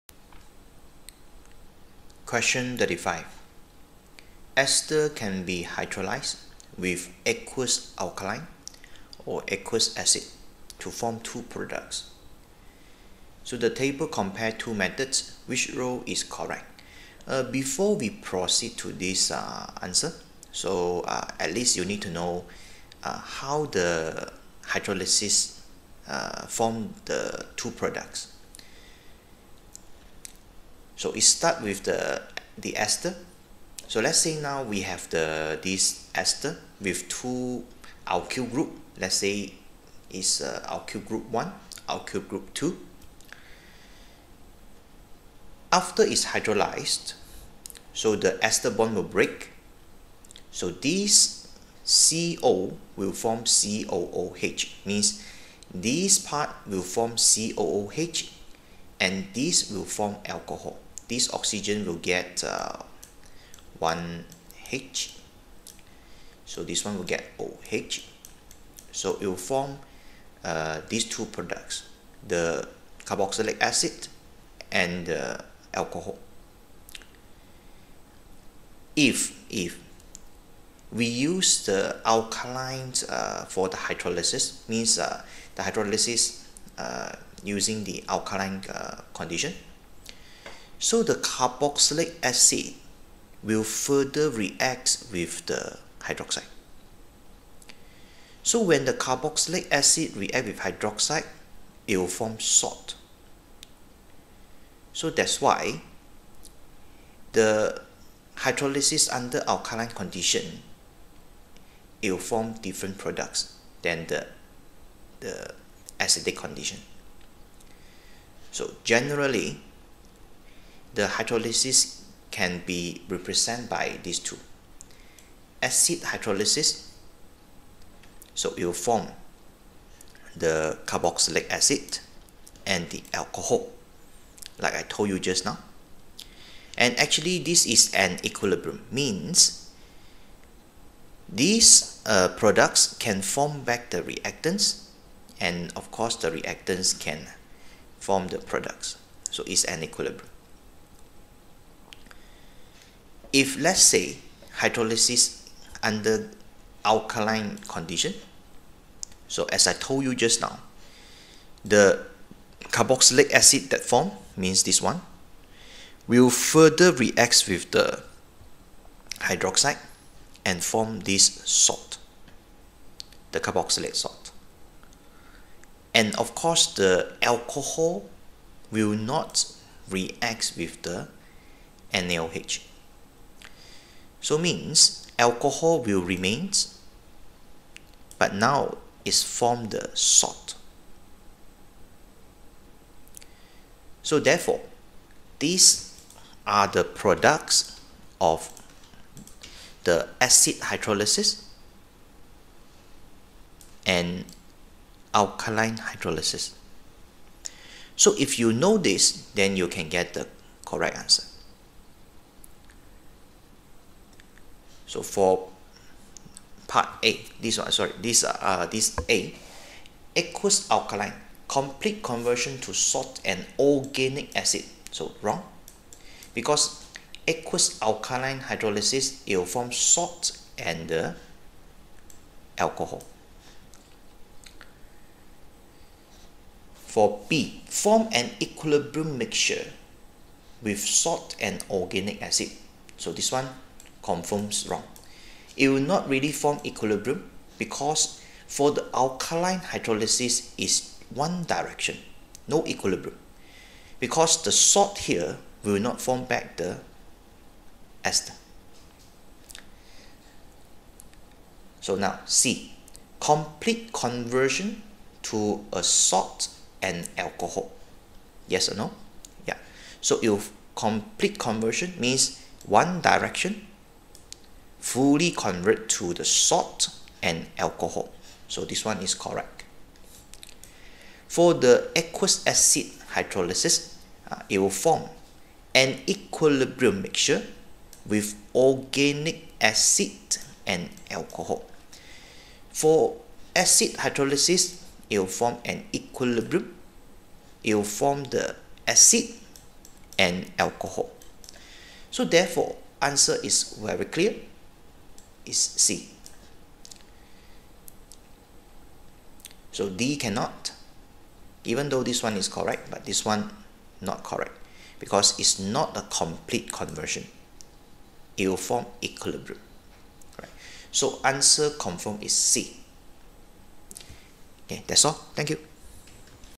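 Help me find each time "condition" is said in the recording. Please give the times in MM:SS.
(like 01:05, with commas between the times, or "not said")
01:29, 01:49, 01:56, 02:37.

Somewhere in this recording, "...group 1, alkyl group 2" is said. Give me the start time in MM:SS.
00:41.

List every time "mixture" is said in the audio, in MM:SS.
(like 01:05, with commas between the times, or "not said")
03:59, 04:47.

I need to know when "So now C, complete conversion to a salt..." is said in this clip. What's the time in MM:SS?
04:21.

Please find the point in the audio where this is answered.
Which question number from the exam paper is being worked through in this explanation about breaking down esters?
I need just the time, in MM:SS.
00:02.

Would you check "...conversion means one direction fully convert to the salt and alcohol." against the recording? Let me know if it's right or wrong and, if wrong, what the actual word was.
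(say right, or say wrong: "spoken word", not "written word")
right.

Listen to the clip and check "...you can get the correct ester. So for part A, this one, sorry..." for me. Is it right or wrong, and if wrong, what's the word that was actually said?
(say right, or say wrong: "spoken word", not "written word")
wrong: "answer", not "ester".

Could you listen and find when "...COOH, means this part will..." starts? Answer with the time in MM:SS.
00:53.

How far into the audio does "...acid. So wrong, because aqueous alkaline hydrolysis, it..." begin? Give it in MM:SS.
03:44.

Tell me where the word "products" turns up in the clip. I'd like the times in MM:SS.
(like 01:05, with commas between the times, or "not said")
00:11, 00:27, 01:11, 01:52, 02:22, 02:28, 03:16.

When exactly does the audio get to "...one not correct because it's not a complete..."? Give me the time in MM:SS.
05:13.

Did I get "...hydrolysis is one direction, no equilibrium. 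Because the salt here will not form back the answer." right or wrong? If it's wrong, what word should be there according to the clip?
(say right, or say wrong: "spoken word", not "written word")
wrong: "ester", not "answer".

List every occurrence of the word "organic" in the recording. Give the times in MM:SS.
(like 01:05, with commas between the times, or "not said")
03:43, 04:01, 04:48.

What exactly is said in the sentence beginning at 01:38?
So when the carboxylic acid react with hydroxide, it will form salt.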